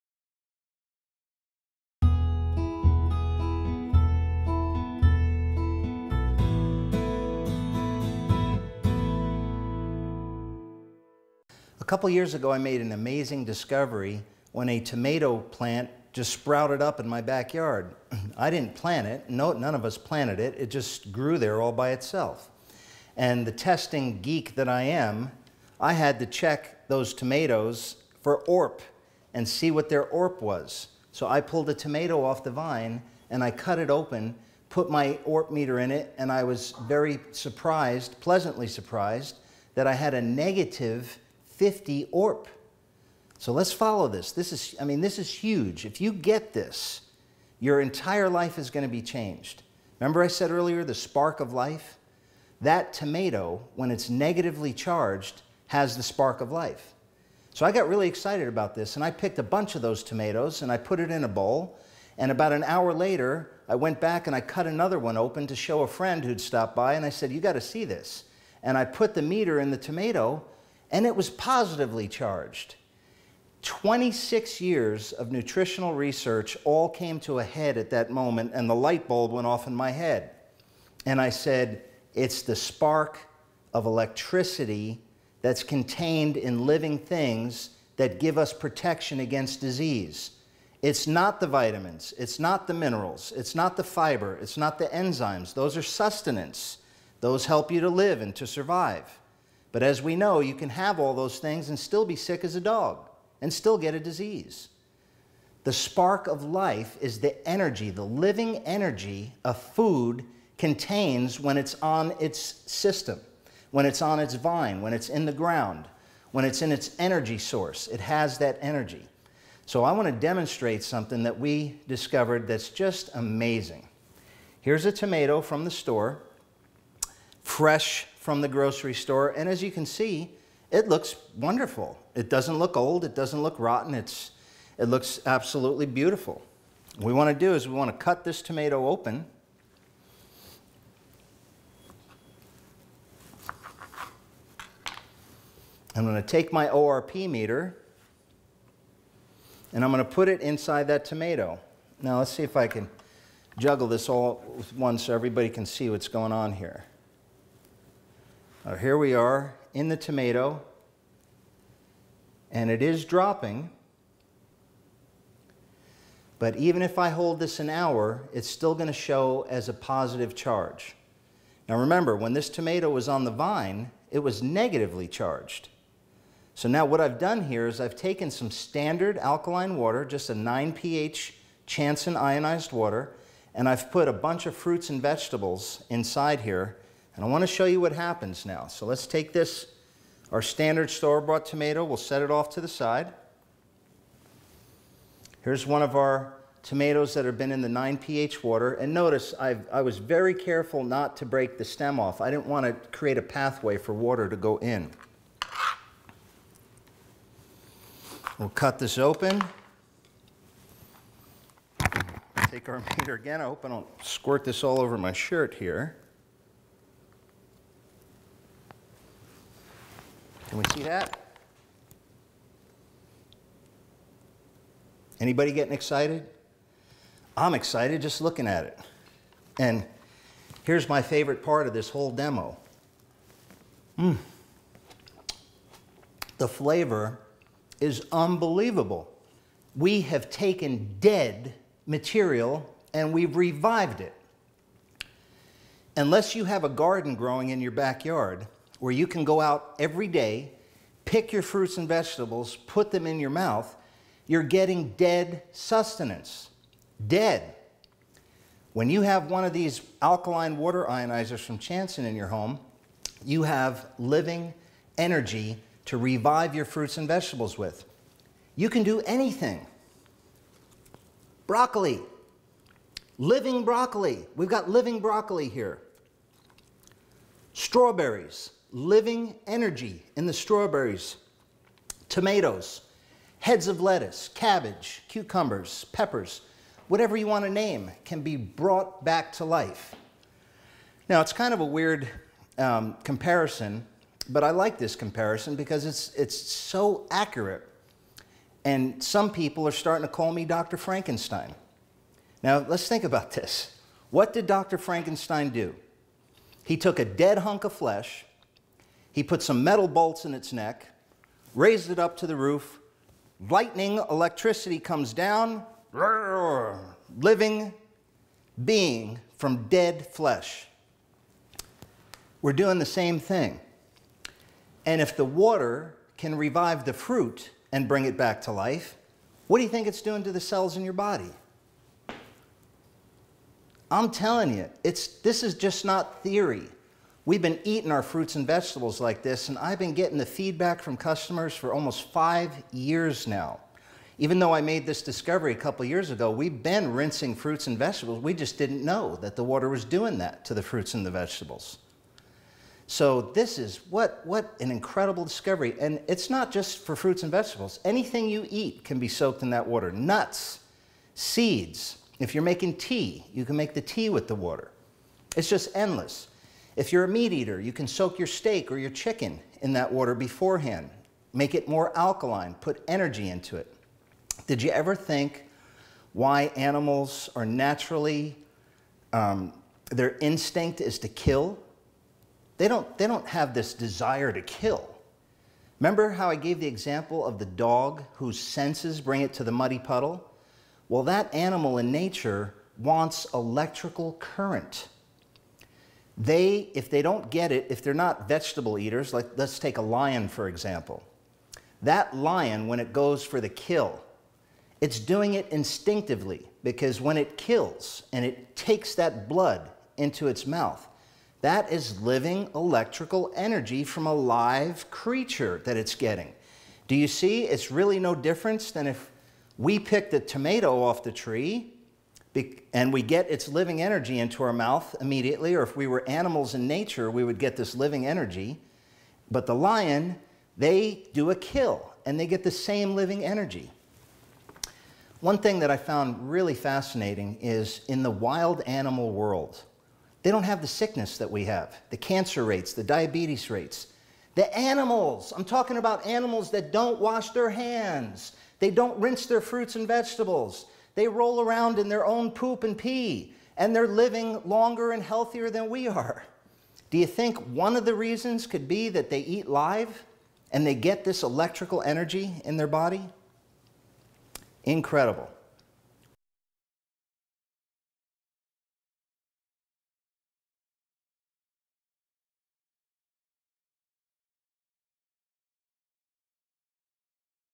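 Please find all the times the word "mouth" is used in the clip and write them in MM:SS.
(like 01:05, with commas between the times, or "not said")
04:13, 06:50, 07:04.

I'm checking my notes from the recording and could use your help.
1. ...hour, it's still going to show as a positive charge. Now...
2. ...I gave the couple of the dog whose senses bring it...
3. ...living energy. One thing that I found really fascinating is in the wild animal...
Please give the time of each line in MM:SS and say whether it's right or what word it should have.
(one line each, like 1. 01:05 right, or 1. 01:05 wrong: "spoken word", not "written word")
1. 02:47 right
2. 06:26 wrong: "example", not "couple"
3. 07:12 right.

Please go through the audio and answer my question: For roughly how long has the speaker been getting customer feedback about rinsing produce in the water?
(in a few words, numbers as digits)
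almost 5 years.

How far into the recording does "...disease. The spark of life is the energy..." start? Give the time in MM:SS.
01:43.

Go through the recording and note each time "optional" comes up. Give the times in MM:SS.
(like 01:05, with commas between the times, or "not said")
not said.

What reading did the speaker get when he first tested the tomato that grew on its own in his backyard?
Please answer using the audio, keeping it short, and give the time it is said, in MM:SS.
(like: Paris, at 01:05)
-50, at 00:40.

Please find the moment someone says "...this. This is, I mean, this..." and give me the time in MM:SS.
00:44.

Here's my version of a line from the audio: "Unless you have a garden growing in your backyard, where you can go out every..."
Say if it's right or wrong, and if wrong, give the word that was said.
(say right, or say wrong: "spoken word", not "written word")
right.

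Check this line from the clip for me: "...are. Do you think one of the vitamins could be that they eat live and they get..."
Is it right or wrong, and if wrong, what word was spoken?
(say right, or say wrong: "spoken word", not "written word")
wrong: "reasons", not "vitamins".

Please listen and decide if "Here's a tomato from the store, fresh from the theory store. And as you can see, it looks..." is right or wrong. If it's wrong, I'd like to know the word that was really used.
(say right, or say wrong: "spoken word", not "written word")
wrong: "grocery", not "theory".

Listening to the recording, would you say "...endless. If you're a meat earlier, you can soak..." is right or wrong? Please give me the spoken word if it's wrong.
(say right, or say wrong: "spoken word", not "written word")
wrong: "eater", not "earlier".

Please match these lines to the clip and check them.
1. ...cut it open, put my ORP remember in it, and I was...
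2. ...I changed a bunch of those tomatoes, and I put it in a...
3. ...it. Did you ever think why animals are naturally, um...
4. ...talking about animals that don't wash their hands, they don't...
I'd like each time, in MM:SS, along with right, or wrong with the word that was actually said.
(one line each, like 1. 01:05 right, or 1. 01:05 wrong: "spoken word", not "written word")
1. 00:33 wrong: "meter", not "remember"
2. 00:59 wrong: "picked", not "changed"
3. 06:13 right
4. 07:25 right.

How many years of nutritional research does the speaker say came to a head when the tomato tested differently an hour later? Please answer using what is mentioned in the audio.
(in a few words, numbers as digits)
26.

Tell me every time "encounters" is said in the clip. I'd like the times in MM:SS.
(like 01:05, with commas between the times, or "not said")
not said.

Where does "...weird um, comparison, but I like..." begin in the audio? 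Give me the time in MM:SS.
04:51.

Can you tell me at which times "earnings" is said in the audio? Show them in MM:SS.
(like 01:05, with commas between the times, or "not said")
not said.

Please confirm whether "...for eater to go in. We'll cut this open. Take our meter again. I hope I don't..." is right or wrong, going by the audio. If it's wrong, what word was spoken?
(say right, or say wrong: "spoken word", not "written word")
wrong: "water", not "eater".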